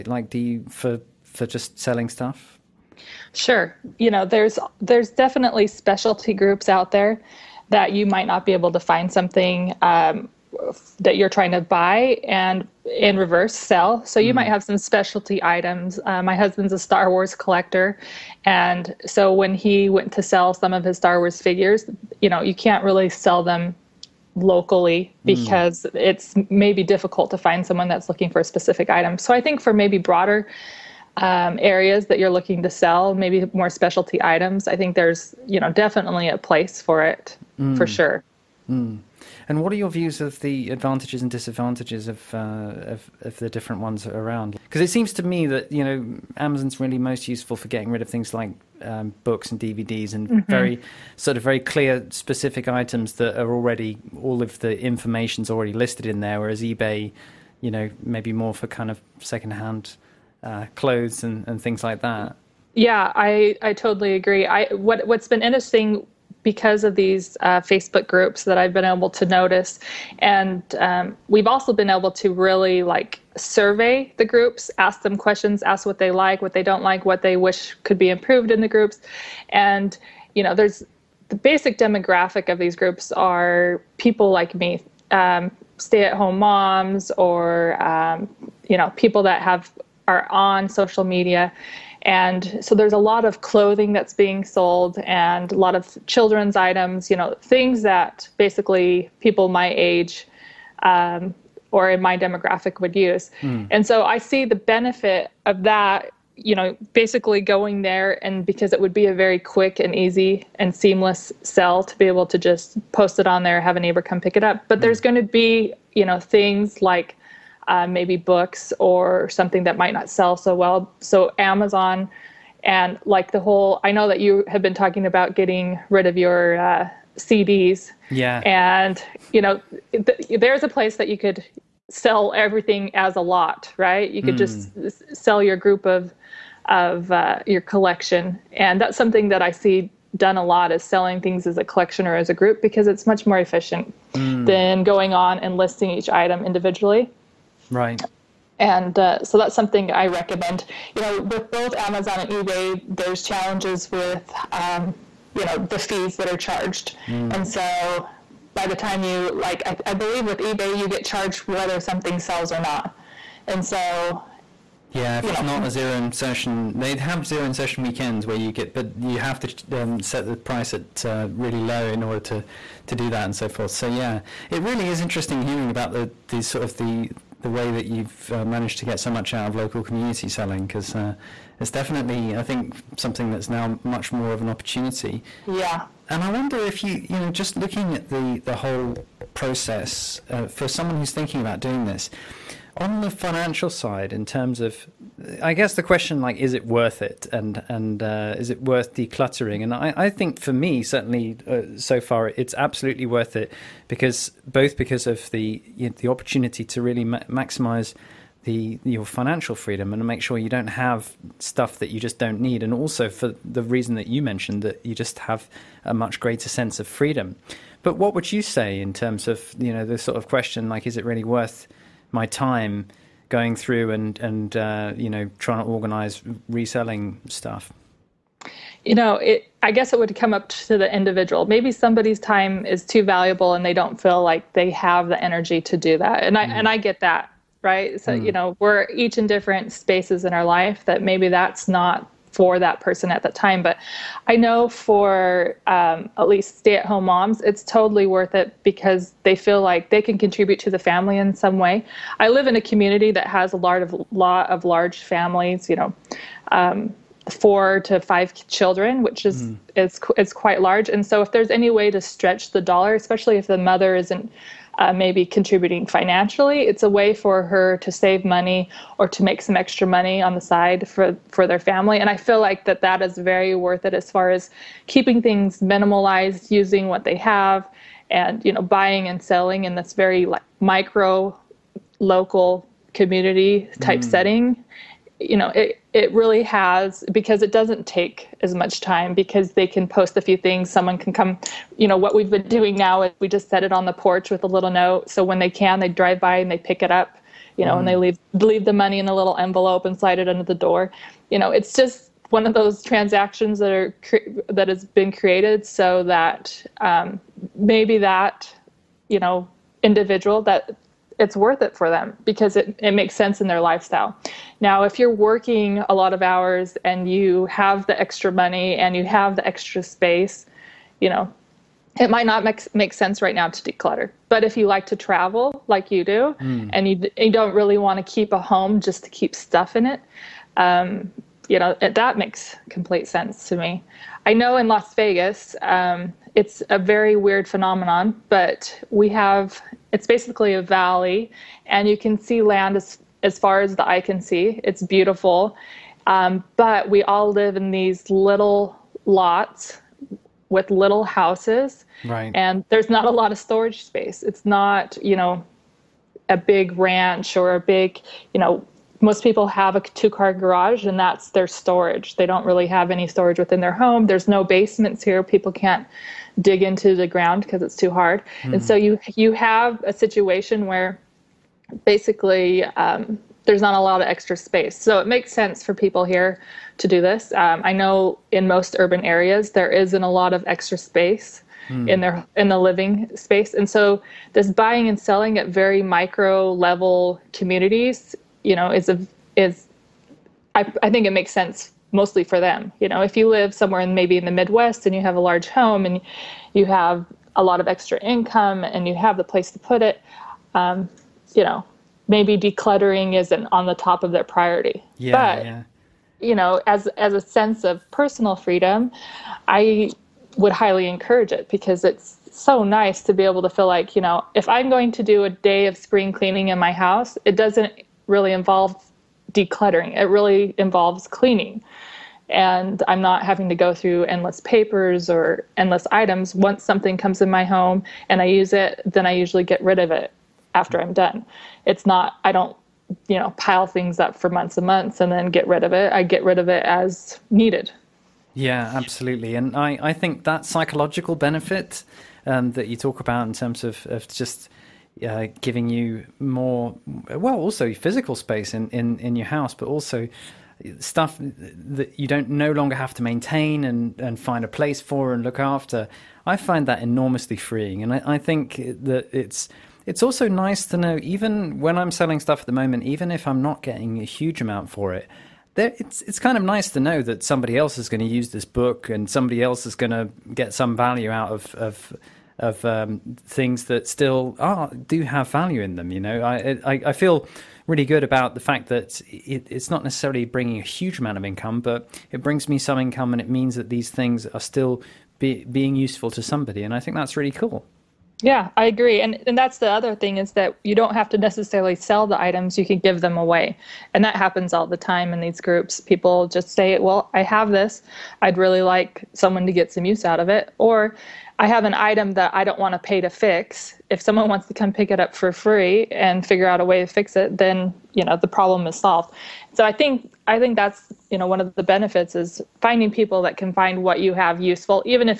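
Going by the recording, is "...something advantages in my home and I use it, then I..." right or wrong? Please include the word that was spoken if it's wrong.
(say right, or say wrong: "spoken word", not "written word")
wrong: "comes", not "advantages".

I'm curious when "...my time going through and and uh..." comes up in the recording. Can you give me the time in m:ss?
3:42.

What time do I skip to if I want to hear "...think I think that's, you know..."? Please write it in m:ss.
8:29.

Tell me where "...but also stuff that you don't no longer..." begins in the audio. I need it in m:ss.
7:29.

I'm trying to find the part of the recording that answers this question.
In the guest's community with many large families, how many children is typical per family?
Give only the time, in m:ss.
4:17.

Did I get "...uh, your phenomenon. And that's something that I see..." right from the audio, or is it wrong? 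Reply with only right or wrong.
wrong.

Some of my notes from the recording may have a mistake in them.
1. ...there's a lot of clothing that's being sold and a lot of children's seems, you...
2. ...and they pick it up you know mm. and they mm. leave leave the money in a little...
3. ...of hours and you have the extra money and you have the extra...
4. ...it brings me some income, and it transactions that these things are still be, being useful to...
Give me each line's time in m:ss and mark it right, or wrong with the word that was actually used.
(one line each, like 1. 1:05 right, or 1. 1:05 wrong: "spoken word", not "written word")
1. 1:32 wrong: "items", not "seems"
2. 4:56 right
3. 5:16 right
4. 8:02 wrong: "means", not "transactions".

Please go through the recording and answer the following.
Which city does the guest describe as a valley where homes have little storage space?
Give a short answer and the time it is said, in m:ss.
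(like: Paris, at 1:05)
Las Vegas, at 5:34.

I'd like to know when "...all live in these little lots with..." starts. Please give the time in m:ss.
5:47.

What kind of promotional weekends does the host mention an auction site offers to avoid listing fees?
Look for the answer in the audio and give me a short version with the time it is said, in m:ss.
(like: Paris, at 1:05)
zero insertion weekends, at 2:47.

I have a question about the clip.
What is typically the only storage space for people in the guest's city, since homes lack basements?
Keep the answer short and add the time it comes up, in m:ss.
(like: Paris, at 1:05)
two car garage, at 5:59.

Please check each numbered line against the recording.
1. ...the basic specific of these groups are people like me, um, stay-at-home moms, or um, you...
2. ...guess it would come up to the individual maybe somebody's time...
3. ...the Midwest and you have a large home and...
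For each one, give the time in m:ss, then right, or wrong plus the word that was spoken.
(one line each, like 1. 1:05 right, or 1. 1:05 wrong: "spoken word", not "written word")
1. 1:21 wrong: "demographic", not "specific"
2. 3:49 right
3. 6:34 right.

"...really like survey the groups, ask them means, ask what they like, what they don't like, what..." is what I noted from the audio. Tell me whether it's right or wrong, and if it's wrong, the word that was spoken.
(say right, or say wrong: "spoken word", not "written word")
wrong: "questions", not "means".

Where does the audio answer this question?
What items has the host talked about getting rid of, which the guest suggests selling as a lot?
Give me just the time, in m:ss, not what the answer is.
2:07.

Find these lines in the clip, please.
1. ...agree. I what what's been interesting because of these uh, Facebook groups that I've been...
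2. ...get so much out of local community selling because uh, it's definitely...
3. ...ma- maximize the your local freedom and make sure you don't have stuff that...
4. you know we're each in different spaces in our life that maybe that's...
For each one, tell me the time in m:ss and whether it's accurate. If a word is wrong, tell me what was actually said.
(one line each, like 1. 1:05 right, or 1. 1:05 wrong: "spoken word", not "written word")
1. 1:04 right
2. 2:58 right
3. 3:27 wrong: "financial", not "local"
4. 3:58 right.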